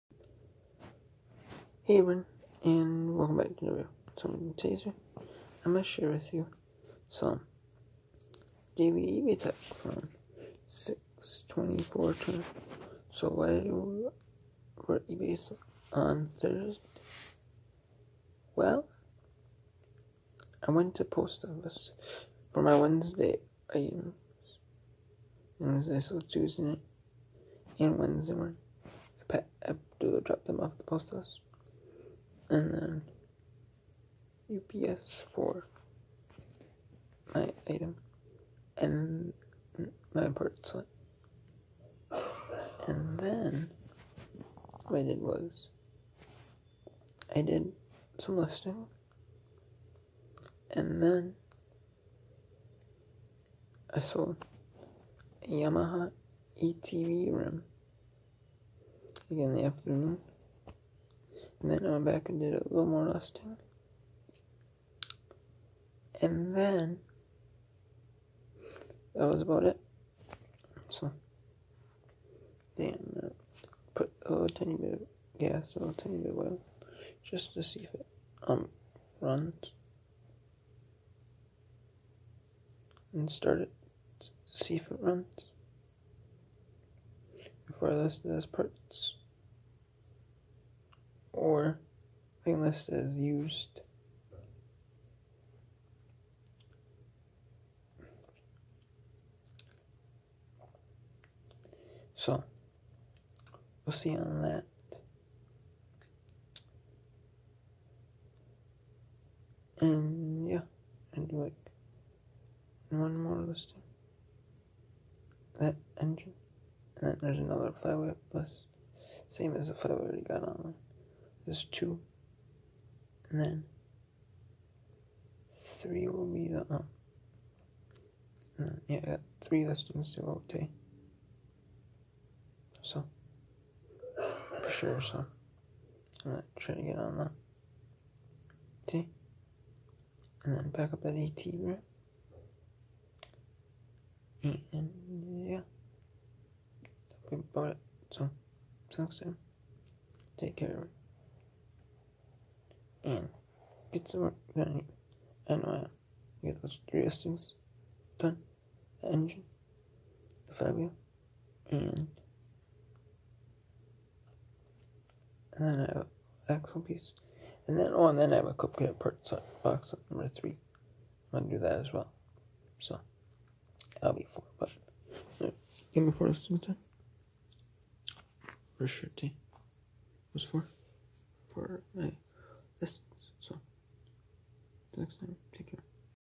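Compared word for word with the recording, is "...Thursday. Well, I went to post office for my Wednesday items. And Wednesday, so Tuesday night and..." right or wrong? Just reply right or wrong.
right.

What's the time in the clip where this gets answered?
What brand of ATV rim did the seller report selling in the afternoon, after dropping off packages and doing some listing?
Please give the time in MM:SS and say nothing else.
00:55.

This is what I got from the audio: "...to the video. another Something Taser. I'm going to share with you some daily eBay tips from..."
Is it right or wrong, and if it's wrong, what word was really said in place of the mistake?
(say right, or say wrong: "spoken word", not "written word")
right.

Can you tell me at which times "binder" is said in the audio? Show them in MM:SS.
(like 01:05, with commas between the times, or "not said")
not said.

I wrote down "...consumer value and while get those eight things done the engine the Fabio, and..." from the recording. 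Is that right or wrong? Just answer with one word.
wrong.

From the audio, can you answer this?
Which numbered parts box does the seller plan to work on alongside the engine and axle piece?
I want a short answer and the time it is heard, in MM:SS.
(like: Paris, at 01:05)
Number three, at 02:50.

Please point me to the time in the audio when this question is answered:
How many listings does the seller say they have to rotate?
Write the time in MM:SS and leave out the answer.
02:09.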